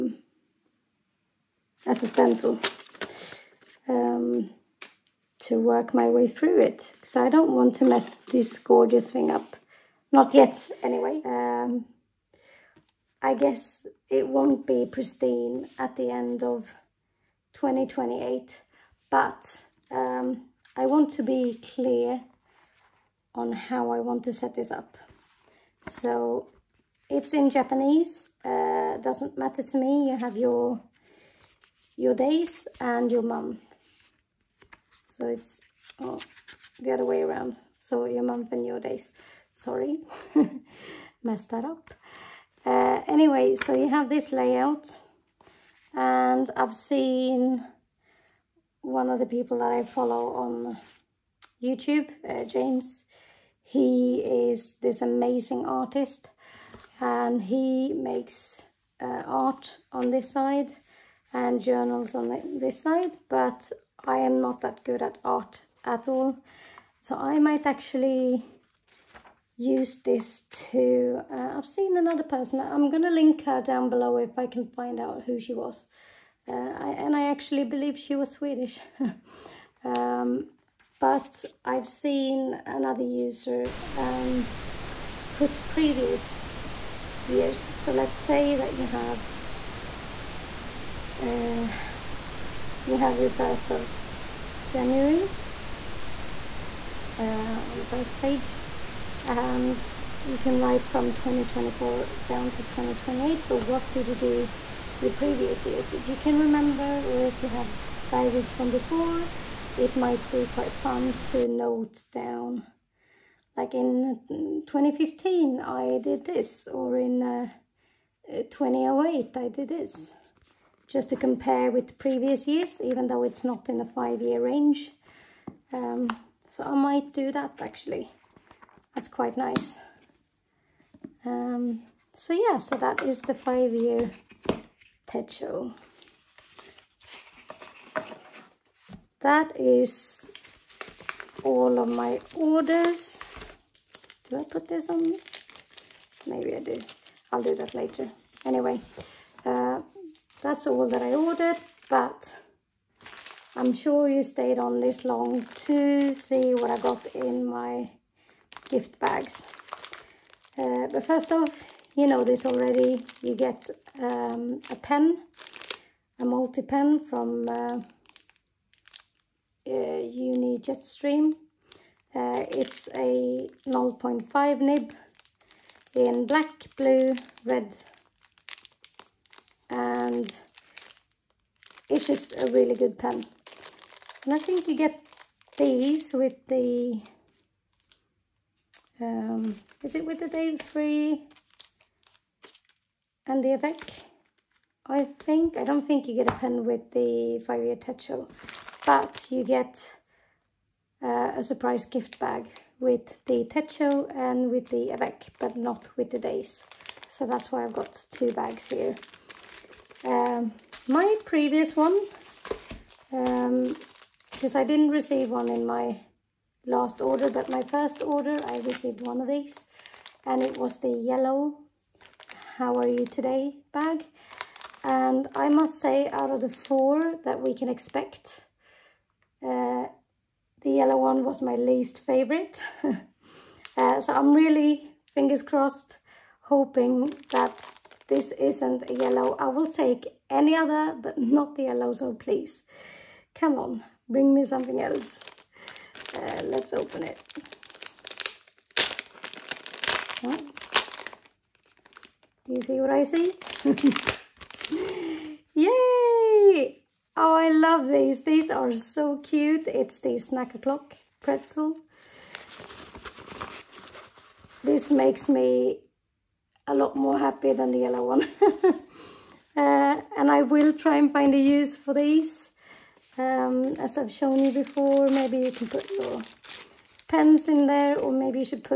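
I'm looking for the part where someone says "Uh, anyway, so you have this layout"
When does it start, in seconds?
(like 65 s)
42 s.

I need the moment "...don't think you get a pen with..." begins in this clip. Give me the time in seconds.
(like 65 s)
195 s.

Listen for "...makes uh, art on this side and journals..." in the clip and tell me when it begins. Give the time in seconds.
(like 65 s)
57 s.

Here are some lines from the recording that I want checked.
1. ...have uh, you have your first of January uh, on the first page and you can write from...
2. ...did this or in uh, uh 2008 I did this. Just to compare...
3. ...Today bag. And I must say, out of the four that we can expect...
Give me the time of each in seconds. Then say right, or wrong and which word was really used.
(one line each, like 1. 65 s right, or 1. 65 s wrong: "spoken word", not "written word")
1. 88 s right
2. 115 s right
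3. 223 s right.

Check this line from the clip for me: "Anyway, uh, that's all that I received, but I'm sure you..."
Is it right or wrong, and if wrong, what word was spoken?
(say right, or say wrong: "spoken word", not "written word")
wrong: "ordered", not "received".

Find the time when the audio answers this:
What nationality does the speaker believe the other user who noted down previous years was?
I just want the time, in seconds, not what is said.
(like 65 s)
78 s.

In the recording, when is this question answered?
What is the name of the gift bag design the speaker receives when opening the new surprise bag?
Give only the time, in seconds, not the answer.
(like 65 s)
260 s.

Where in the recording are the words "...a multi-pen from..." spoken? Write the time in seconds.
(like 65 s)
166 s.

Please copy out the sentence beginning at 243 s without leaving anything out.
Come on, bring me something else.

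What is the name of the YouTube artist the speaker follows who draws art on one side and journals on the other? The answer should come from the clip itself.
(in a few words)
James.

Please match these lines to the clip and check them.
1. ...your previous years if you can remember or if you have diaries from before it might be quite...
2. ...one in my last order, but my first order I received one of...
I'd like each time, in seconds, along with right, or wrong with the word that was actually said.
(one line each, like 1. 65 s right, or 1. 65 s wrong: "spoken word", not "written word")
1. 104 s right
2. 215 s right.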